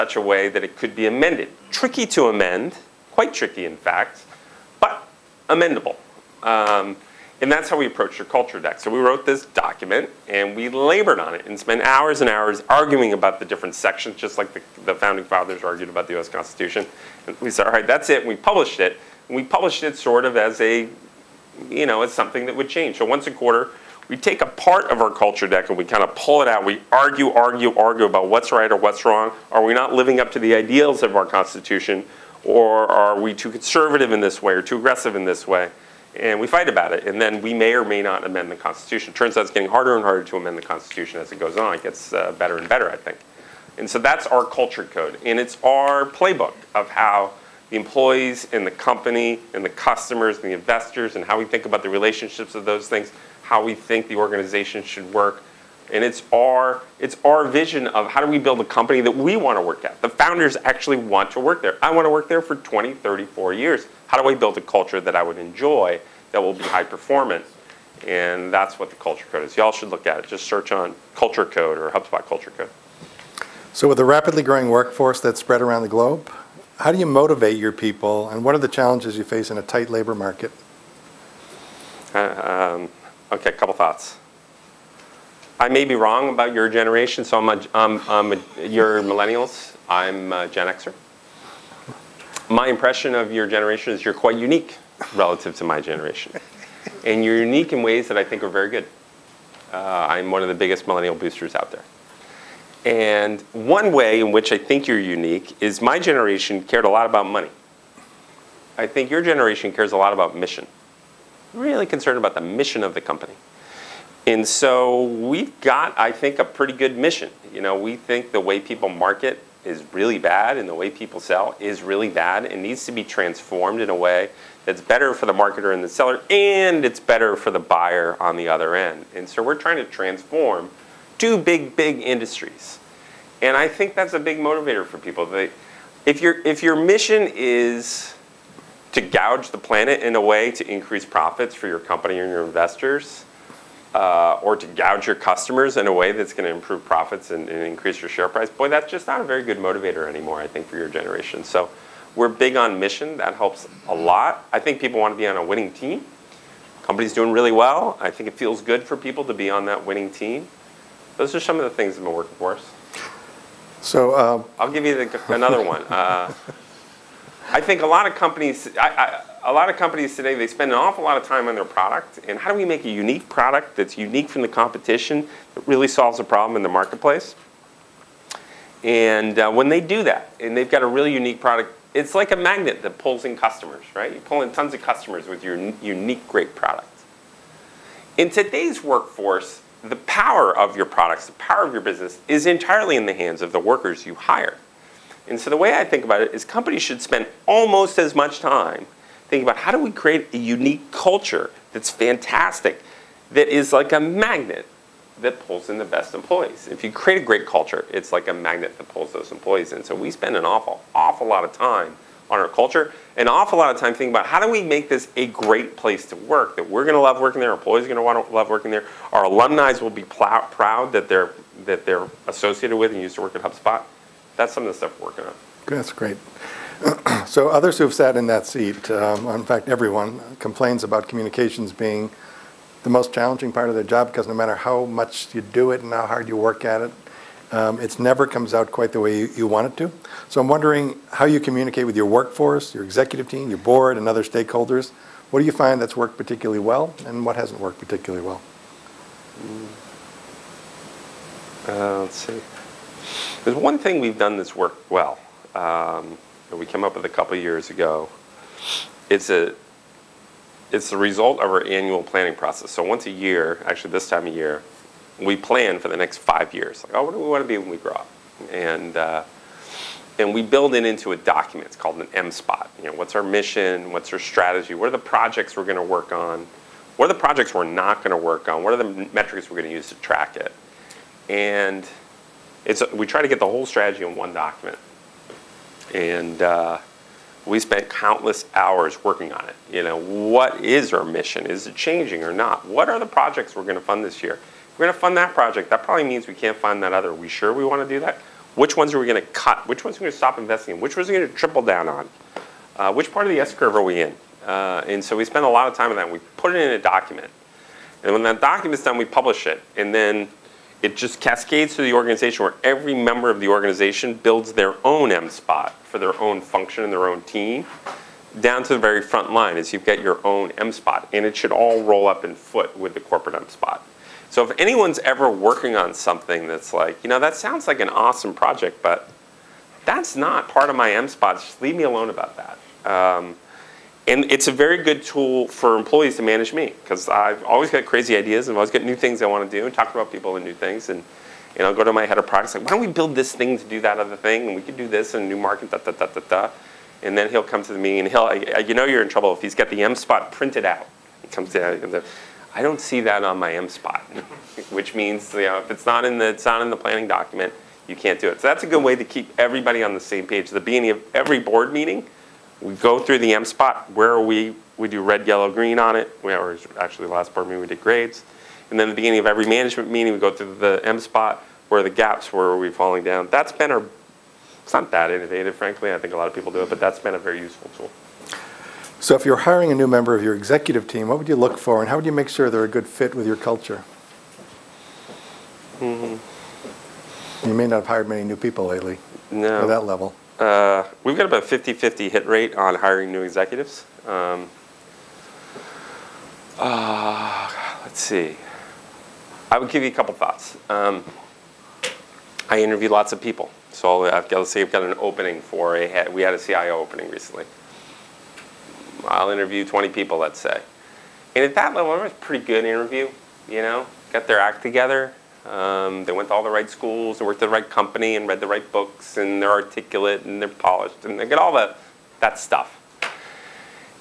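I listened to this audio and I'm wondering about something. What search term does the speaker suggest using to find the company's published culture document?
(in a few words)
HubSpot culture code.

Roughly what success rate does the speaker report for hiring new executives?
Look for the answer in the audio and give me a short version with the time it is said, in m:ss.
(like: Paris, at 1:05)
50-50, at 6:31.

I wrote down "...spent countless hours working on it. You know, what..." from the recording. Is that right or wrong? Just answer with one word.
right.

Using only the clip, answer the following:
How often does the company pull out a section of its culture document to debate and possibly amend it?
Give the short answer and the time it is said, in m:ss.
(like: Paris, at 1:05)
Once a quarter, at 0:23.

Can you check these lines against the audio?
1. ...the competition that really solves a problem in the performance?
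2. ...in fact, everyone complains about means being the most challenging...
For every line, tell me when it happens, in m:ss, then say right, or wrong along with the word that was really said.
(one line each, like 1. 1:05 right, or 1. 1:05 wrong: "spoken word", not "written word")
1. 2:54 wrong: "marketplace", not "performance"
2. 3:49 wrong: "communications", not "means".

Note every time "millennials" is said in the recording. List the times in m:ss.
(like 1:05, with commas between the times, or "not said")
1:29, 1:40.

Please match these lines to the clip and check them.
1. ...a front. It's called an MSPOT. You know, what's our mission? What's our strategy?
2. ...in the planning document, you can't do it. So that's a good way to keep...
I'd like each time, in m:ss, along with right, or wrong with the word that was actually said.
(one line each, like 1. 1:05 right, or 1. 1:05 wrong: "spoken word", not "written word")
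1. 4:31 wrong: "document", not "front"
2. 5:56 right.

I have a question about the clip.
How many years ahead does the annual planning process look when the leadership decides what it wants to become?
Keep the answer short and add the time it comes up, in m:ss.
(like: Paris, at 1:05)
5, at 4:25.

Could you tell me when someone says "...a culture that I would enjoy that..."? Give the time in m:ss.
1:04.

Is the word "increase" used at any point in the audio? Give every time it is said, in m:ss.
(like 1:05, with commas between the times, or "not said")
2:20, 2:27.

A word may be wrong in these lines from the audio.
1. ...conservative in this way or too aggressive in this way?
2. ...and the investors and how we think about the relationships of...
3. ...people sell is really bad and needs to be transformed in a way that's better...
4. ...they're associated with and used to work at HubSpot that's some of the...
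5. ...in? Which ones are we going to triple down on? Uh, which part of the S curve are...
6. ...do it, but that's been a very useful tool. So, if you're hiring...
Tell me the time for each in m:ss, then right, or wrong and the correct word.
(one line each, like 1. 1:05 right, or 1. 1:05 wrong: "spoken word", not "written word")
1. 0:33 right
2. 0:50 right
3. 2:00 right
4. 3:41 right
5. 5:00 right
6. 6:16 right.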